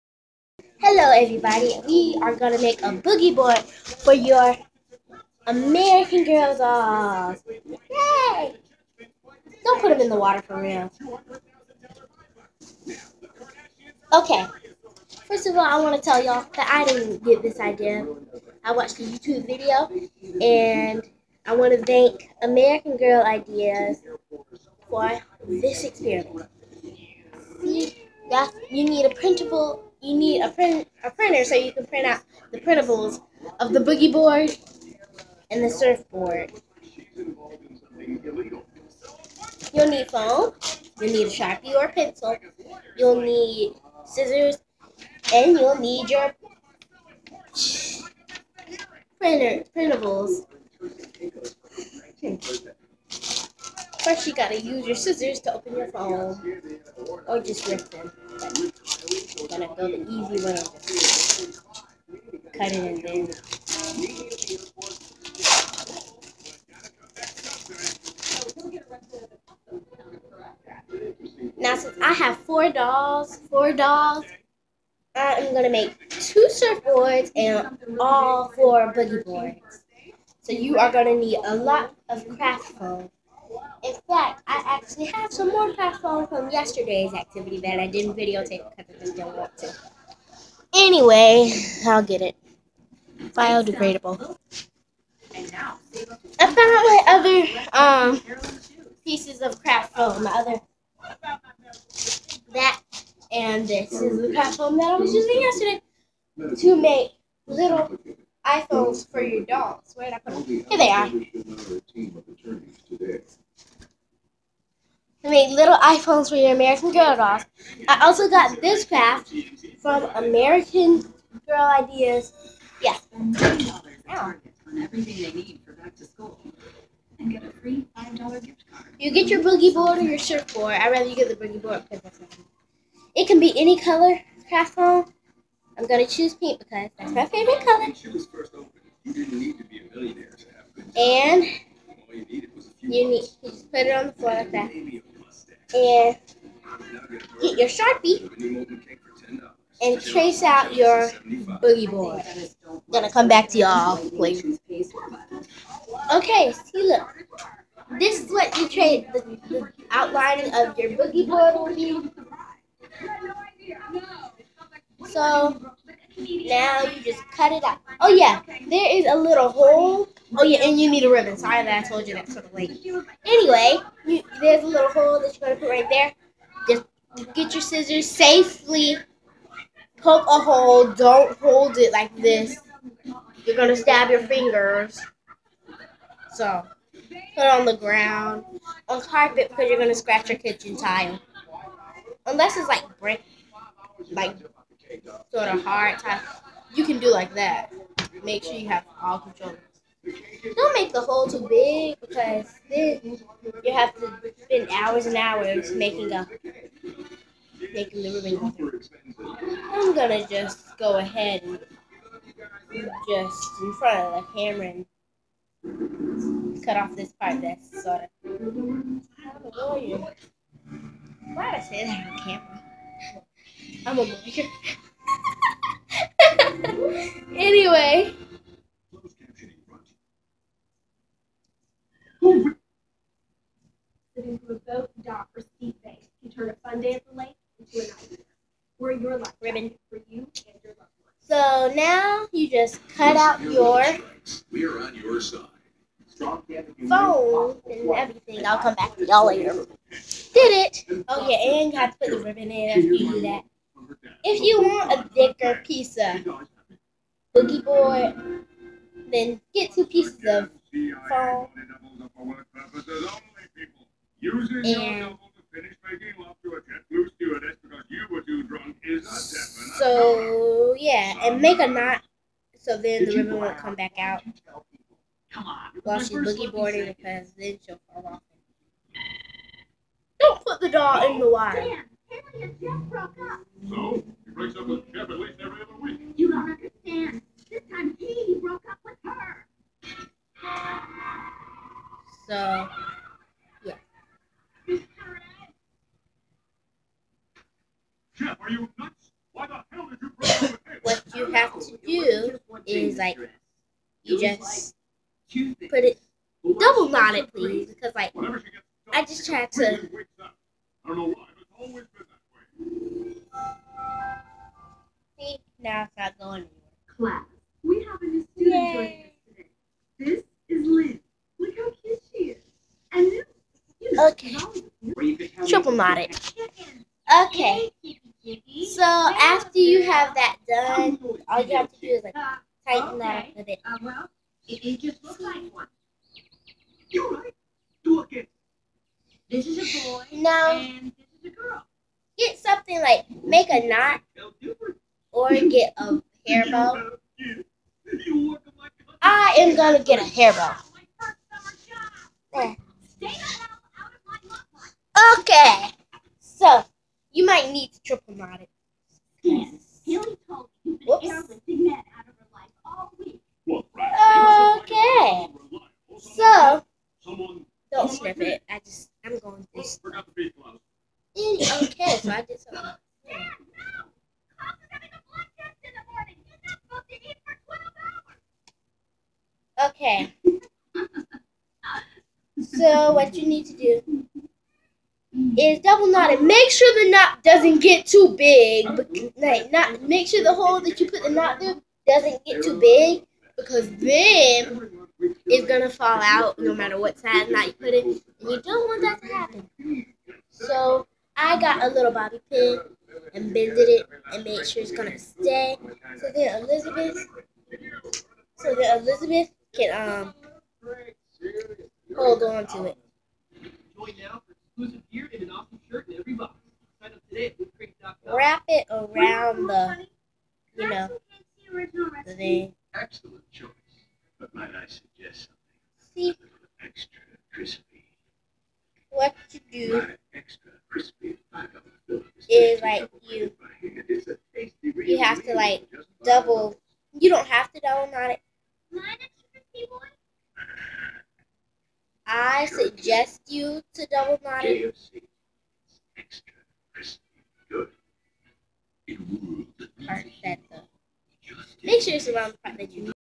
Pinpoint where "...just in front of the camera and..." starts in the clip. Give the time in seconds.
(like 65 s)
213 s.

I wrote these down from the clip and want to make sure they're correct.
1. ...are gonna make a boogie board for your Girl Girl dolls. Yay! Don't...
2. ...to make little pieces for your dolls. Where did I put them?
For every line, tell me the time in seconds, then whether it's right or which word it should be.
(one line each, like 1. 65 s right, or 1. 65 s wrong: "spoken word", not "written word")
1. 2 s wrong: "American", not "Girl"
2. 106 s wrong: "iPhones", not "pieces".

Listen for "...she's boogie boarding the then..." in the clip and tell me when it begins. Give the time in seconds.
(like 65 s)
275 s.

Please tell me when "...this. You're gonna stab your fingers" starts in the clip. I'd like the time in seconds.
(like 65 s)
182 s.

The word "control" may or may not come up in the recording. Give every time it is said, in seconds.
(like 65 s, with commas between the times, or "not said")
199 s.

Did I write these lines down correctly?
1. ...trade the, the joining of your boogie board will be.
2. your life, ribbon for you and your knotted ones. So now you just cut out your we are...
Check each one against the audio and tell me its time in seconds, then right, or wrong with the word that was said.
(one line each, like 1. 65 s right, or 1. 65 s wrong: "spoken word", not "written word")
1. 158 s wrong: "outlining", not "joining"
2. 239 s wrong: "loved", not "knotted".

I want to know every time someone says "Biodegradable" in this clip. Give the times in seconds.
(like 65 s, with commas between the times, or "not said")
93 s.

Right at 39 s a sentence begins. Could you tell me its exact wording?
You'll need foam, you'll need a sharpie or a pencil, you'll need scissors, and you'll need your printer printables.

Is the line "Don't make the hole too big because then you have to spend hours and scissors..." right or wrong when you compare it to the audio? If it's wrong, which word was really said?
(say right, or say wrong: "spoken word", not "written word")
wrong: "hours", not "scissors".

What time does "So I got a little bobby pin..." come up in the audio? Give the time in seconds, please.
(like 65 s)
400 s.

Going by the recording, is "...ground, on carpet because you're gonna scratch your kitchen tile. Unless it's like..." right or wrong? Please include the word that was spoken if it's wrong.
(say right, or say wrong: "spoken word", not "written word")
right.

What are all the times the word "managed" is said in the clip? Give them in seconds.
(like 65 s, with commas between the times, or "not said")
not said.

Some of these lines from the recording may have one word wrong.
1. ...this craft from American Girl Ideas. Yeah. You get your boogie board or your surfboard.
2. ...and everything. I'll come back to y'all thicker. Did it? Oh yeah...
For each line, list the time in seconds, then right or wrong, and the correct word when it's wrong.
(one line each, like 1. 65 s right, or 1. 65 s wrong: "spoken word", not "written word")
1. 118 s right
2. 247 s wrong: "later", not "thicker".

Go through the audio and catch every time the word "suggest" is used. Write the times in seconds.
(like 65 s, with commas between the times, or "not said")
424 s, 442 s.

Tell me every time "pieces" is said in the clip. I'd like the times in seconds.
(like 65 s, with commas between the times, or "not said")
99 s, 255 s, 259 s.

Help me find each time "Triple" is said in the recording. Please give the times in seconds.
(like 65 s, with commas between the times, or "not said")
325 s.